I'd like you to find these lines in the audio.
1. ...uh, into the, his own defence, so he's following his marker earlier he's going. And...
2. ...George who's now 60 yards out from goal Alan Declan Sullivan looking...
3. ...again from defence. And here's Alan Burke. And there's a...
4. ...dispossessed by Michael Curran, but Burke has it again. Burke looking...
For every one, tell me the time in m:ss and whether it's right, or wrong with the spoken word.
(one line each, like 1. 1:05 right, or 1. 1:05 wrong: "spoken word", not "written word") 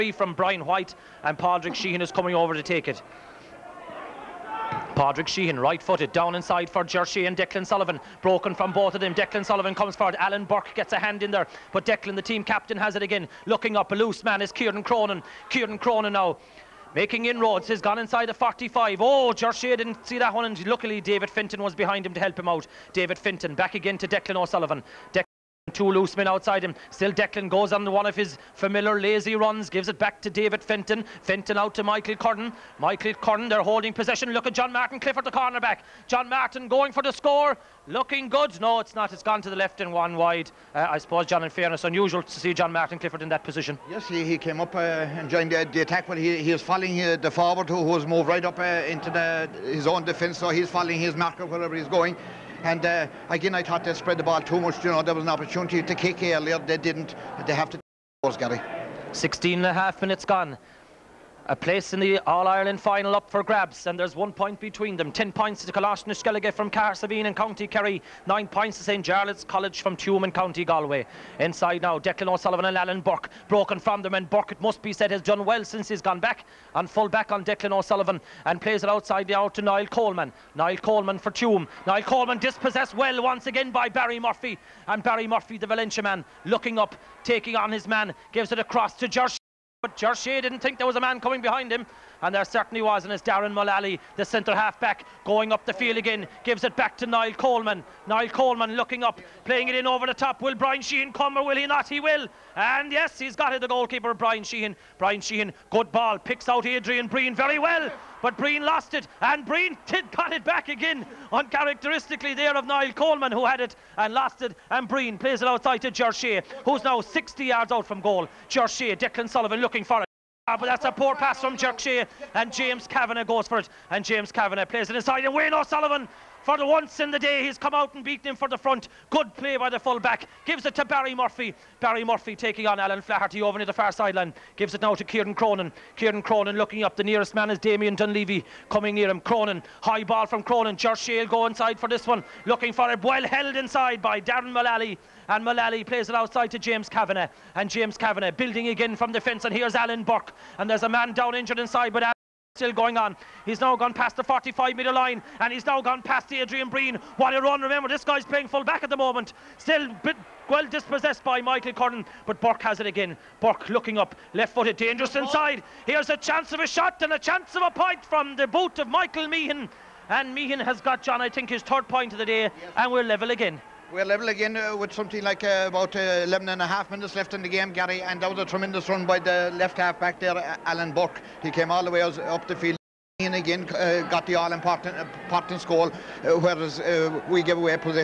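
1. 0:48 wrong: "wherever", not "earlier"
2. 1:55 wrong: "George", not "Alan"
3. 2:28 right
4. 2:40 right.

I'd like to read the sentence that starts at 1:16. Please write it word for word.
And full back on Declan O'Sullivan and plays it outside the out to Niall Coleman.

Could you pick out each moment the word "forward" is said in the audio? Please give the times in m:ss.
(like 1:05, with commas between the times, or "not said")
0:09, 0:47.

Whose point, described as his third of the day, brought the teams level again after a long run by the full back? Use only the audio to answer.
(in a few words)
Michael Meehan.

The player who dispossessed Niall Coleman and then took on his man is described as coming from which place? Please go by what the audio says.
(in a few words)
Valentia.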